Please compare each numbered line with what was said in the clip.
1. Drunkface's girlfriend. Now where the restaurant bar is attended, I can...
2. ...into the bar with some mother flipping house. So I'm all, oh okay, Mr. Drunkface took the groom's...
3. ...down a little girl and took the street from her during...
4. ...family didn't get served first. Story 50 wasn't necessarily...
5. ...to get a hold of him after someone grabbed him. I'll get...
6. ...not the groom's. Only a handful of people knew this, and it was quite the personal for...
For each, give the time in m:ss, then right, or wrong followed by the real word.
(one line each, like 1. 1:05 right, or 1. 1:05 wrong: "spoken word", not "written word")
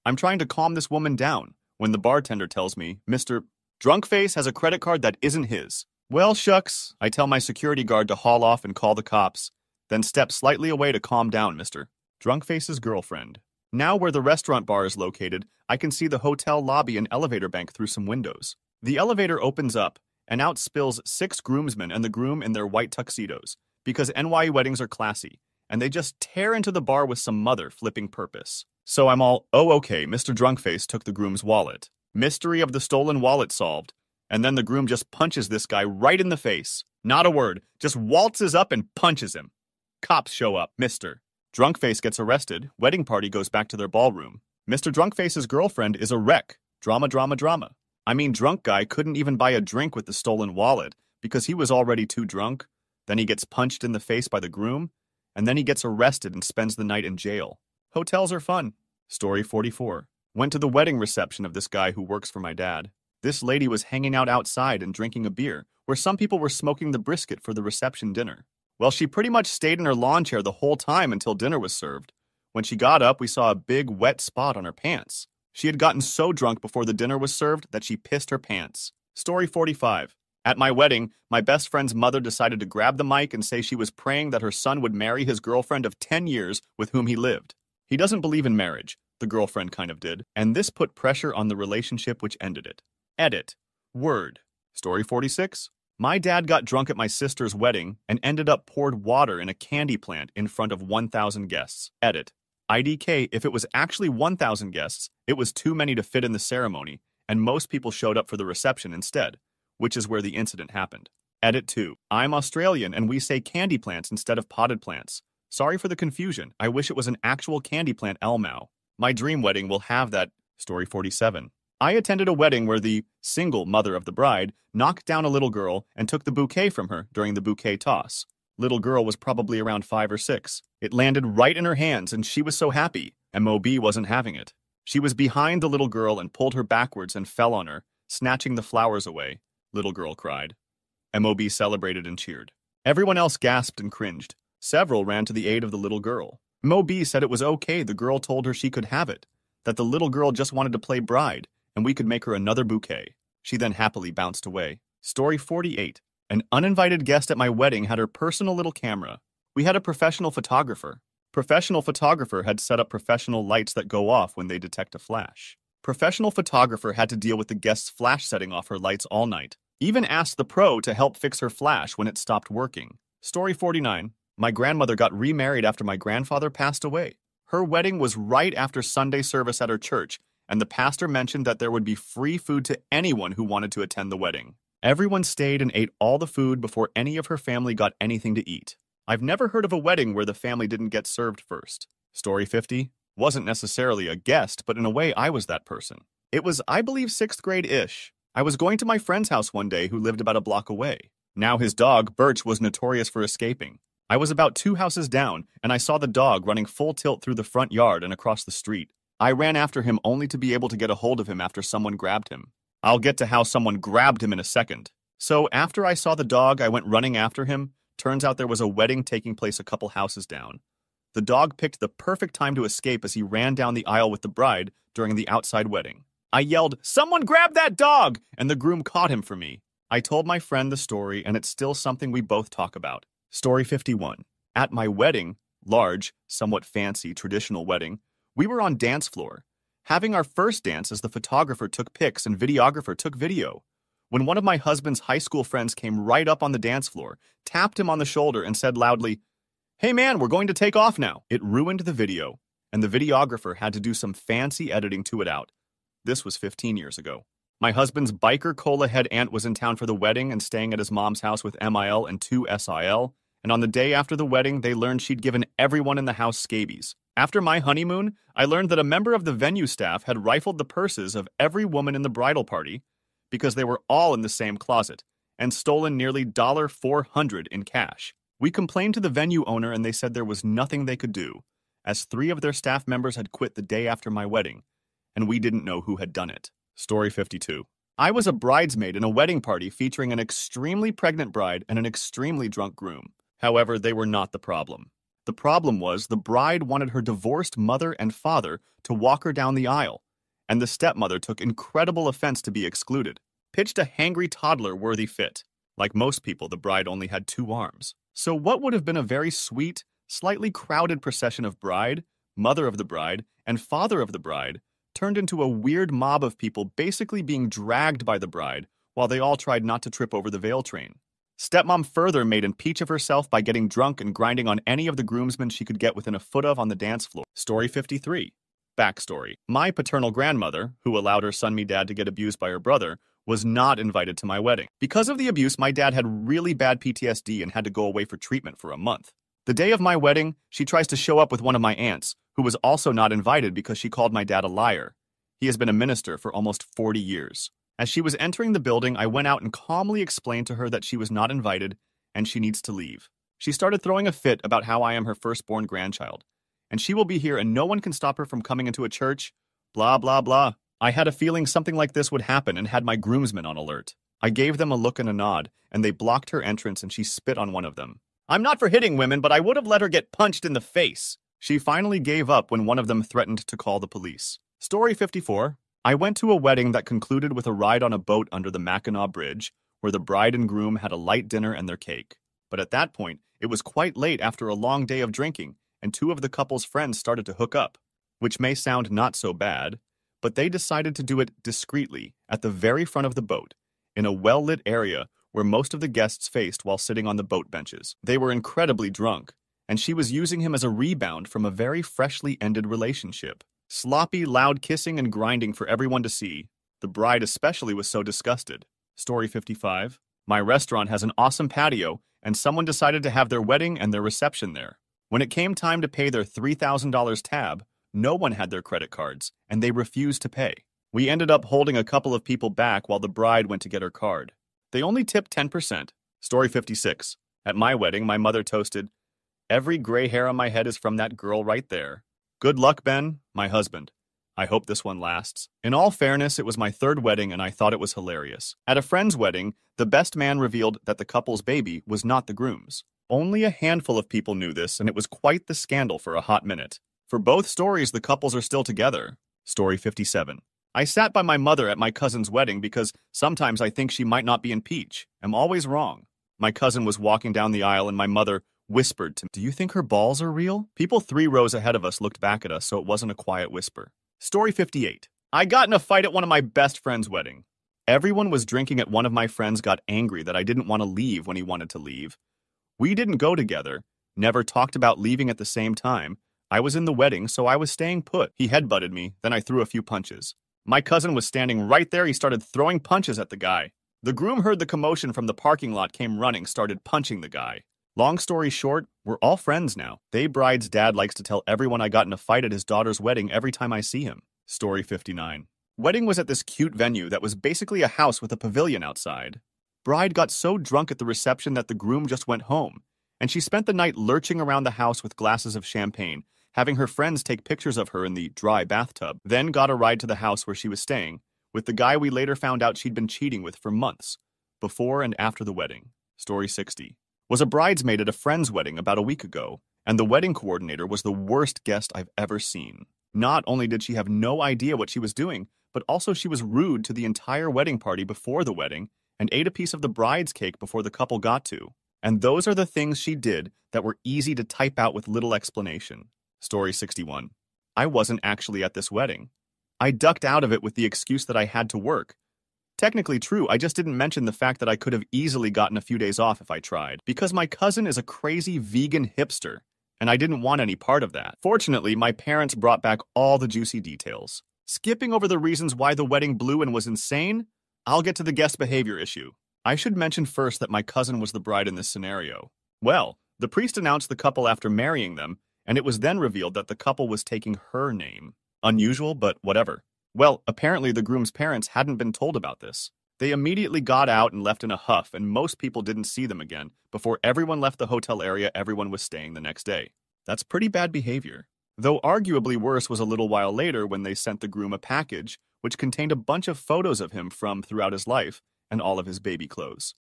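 1. 0:12 wrong: "located", not "attended"
2. 0:26 wrong: "purpose", not "house"
3. 2:05 wrong: "bouquet", not "street"
4. 3:10 right
5. 3:30 right
6. 7:22 wrong: "scandal", not "personal".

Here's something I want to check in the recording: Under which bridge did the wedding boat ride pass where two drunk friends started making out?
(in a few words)
Mackinac Bridge.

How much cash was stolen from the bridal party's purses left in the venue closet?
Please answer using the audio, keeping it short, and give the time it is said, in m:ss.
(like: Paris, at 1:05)
$400, at 4:36.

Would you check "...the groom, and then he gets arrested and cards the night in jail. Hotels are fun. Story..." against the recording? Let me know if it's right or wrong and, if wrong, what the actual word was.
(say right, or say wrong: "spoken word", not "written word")
wrong: "spends", not "cards".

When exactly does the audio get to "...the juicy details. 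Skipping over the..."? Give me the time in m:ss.
9:13.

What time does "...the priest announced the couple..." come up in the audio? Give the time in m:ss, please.
9:23.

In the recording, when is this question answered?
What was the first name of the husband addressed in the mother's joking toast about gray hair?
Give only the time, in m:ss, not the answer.
7:12.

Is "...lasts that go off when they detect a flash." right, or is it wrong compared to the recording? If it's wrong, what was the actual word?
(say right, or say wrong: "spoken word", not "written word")
wrong: "lights", not "lasts".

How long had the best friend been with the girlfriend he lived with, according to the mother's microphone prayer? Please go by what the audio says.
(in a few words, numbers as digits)
10 years.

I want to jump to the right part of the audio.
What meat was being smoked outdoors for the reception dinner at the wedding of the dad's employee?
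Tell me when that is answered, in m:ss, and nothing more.
1:06.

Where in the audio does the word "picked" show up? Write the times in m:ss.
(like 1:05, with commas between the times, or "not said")
3:41.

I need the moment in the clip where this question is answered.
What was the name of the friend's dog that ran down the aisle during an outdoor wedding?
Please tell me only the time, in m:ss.
3:22.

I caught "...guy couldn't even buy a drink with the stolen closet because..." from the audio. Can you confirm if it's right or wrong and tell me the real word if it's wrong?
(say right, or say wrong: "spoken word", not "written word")
wrong: "wallet", not "closet".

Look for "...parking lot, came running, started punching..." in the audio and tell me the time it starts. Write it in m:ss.
8:05.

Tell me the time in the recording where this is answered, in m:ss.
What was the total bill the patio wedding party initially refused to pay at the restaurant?
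6:56.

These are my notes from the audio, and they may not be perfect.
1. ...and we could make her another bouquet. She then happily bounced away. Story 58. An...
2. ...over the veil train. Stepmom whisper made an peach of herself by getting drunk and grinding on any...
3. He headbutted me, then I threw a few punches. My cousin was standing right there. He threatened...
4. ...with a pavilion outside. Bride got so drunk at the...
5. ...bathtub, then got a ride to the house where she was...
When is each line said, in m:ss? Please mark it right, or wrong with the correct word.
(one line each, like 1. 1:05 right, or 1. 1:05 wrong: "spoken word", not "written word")
1. 2:31 wrong: "48", not "58"
2. 5:20 wrong: "further", not "whisper"
3. 7:58 wrong: "started", not "threatened"
4. 8:18 right
5. 8:28 right.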